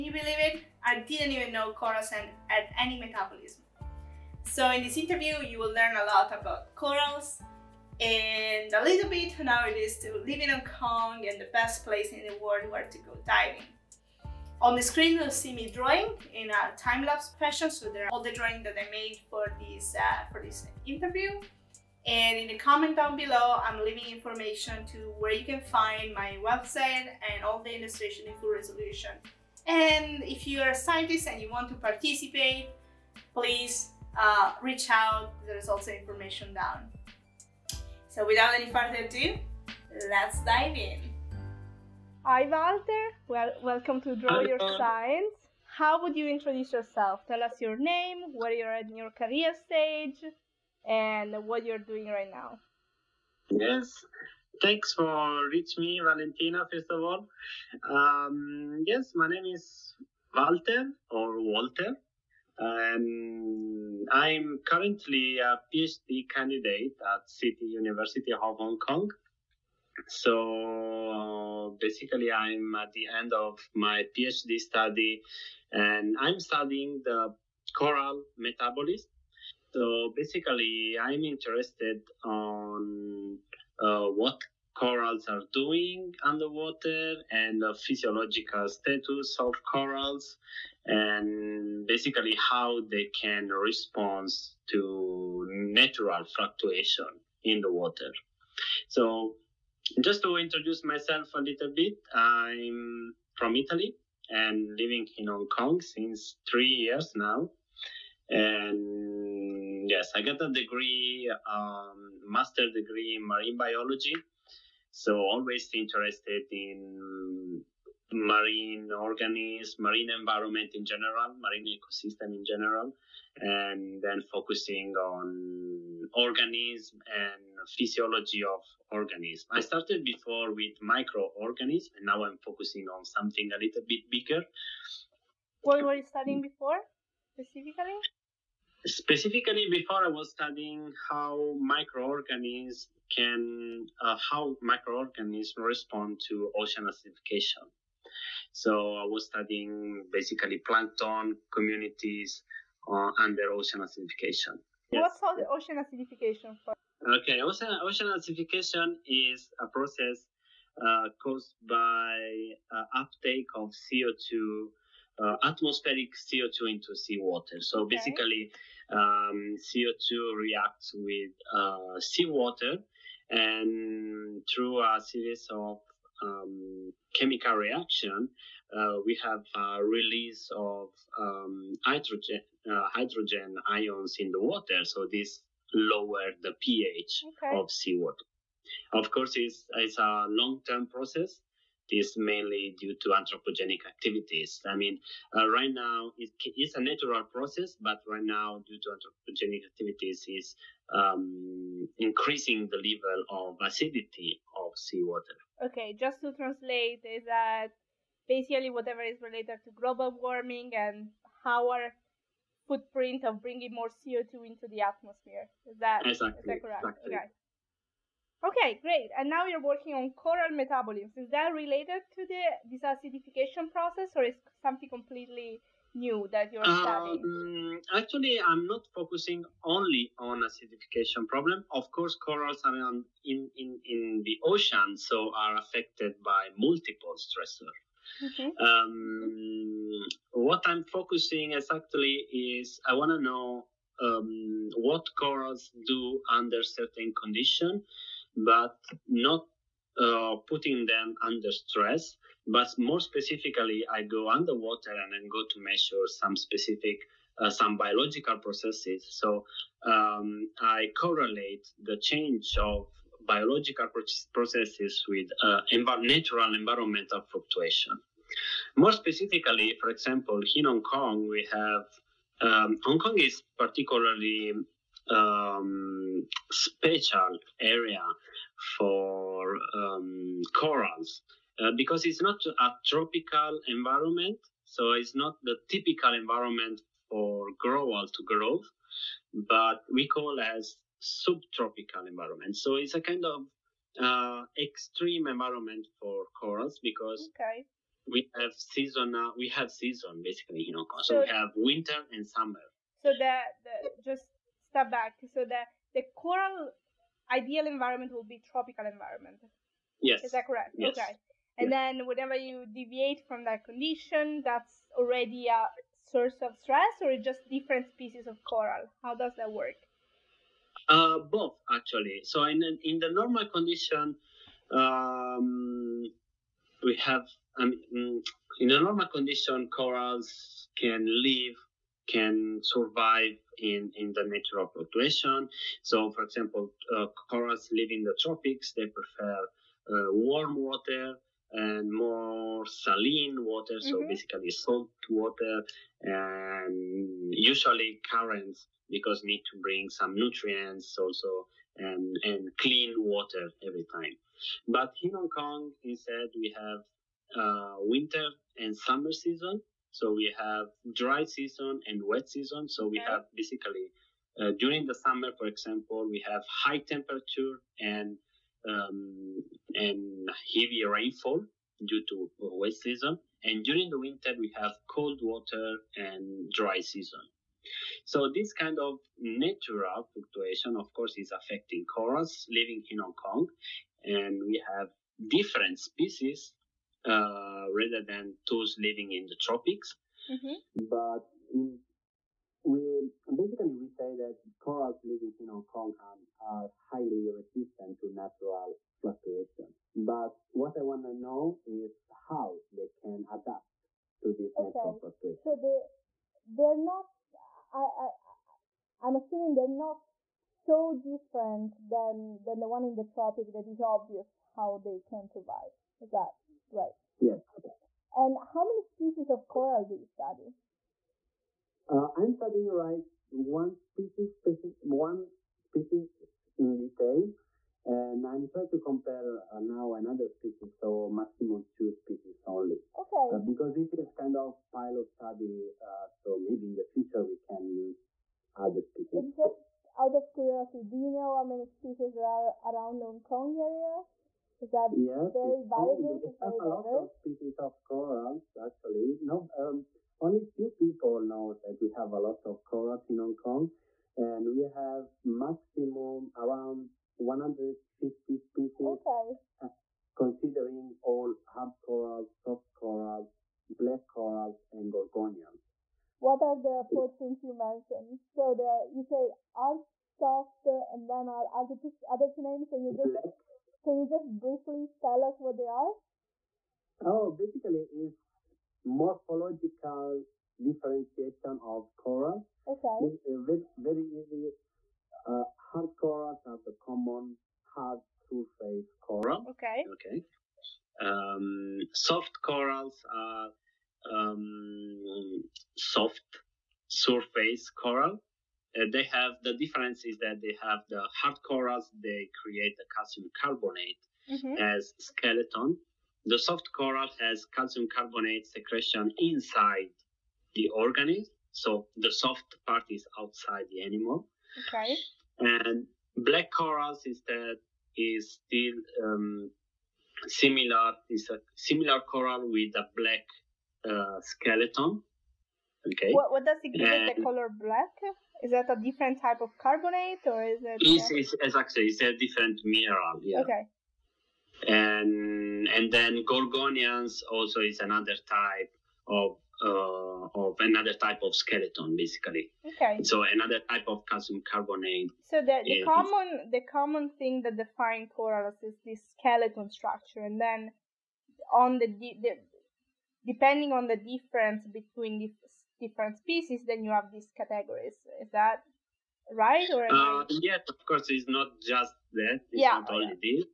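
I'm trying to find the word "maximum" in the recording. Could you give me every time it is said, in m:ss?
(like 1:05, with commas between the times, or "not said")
7:11, 7:35.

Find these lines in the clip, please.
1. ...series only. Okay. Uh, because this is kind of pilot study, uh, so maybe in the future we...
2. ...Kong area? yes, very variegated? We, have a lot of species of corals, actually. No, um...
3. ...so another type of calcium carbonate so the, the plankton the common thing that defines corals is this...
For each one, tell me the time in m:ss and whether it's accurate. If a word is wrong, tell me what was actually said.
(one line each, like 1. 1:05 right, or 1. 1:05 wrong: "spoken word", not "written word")
1. 7:11 wrong: "species", not "series"
2. 7:23 right
3. 9:03 wrong: "common", not "plankton".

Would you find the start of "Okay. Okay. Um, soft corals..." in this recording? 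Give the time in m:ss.
8:09.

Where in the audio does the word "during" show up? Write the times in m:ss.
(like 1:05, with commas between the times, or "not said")
6:04, 6:13.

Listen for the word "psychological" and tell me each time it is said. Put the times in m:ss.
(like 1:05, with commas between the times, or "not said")
not said.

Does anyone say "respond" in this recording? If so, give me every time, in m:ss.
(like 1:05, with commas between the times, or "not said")
1:33, 2:25.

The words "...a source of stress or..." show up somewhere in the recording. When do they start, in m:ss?
5:15.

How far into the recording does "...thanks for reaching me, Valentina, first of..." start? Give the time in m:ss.
0:54.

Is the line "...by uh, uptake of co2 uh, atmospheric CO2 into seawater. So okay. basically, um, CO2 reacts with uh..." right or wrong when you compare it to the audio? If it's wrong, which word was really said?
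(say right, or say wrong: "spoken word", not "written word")
right.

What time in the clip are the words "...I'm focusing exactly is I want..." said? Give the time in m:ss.
4:00.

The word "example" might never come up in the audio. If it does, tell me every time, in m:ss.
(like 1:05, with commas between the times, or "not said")
4:29, 5:36, 6:05.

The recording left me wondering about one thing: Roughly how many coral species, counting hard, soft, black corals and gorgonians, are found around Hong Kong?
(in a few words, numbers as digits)
150.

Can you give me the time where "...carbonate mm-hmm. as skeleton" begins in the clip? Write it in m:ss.
8:23.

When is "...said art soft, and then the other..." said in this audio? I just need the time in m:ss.
7:49.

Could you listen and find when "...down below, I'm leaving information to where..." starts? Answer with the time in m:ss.
0:22.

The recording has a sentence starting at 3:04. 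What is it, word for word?
So this lower the pH okay.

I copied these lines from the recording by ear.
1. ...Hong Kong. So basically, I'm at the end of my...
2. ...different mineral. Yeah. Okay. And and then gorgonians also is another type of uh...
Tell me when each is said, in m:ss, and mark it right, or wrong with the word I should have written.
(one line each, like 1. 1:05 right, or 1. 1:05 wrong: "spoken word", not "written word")
1. 1:08 right
2. 8:52 right.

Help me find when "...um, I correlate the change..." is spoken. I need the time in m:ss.
4:19.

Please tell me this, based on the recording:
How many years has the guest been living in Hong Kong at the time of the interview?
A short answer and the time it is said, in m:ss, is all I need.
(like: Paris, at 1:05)
3, at 1:46.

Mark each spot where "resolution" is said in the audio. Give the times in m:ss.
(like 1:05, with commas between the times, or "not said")
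0:28.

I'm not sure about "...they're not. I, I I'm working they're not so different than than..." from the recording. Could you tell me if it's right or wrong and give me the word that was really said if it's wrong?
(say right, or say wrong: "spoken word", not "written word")
wrong: "assuming", not "working".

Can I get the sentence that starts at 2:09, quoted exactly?
I started before with microorganisms, and now I'm focusing on something a little bit bigger.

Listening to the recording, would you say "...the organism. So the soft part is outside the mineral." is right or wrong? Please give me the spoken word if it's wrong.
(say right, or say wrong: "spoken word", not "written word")
wrong: "animal", not "mineral".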